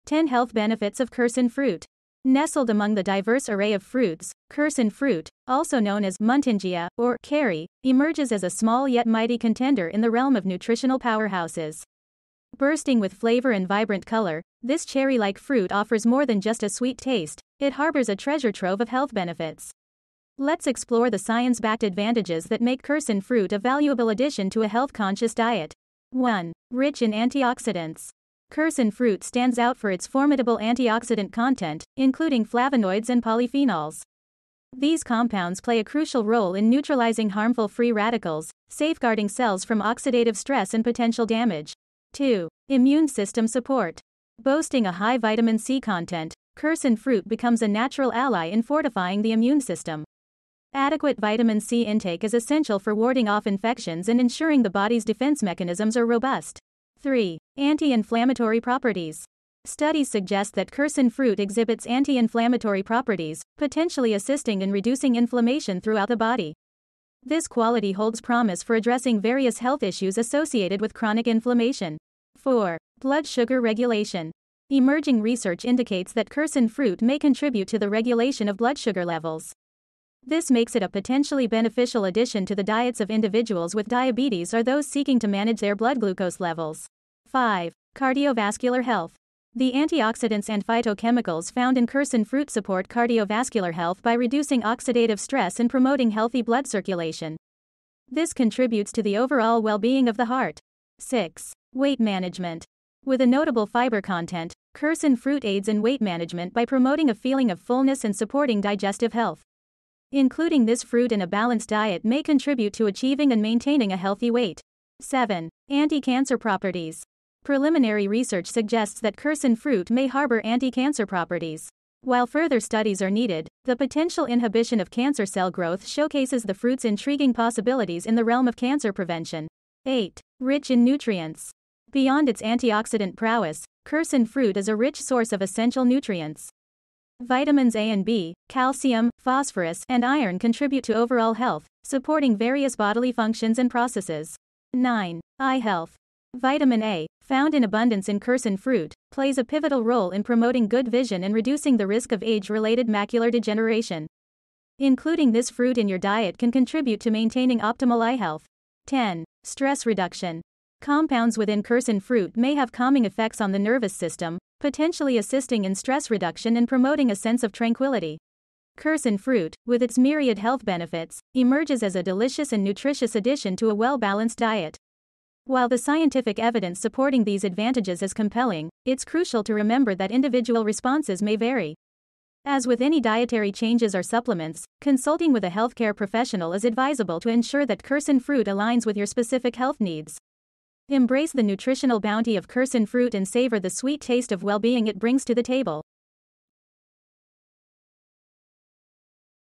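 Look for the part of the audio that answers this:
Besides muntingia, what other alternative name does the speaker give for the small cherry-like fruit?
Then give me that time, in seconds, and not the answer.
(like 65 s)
7 s.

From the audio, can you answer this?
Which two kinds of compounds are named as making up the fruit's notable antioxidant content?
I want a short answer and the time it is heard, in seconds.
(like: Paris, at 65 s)
flavonoids and polyphenols, at 32 s.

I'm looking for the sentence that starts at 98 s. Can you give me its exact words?
This contributes to the overall well being of the heart.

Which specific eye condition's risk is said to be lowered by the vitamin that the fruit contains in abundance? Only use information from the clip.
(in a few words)
age related macular degeneration.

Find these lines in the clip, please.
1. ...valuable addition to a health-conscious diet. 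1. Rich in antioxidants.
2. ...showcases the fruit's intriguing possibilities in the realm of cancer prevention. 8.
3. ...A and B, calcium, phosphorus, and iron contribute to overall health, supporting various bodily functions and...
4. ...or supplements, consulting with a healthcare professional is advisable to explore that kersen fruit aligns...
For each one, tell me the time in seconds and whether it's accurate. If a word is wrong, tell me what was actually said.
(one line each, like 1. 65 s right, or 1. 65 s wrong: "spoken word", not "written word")
1. 23 s right
2. 125 s right
3. 137 s right
4. 183 s wrong: "ensure", not "explore".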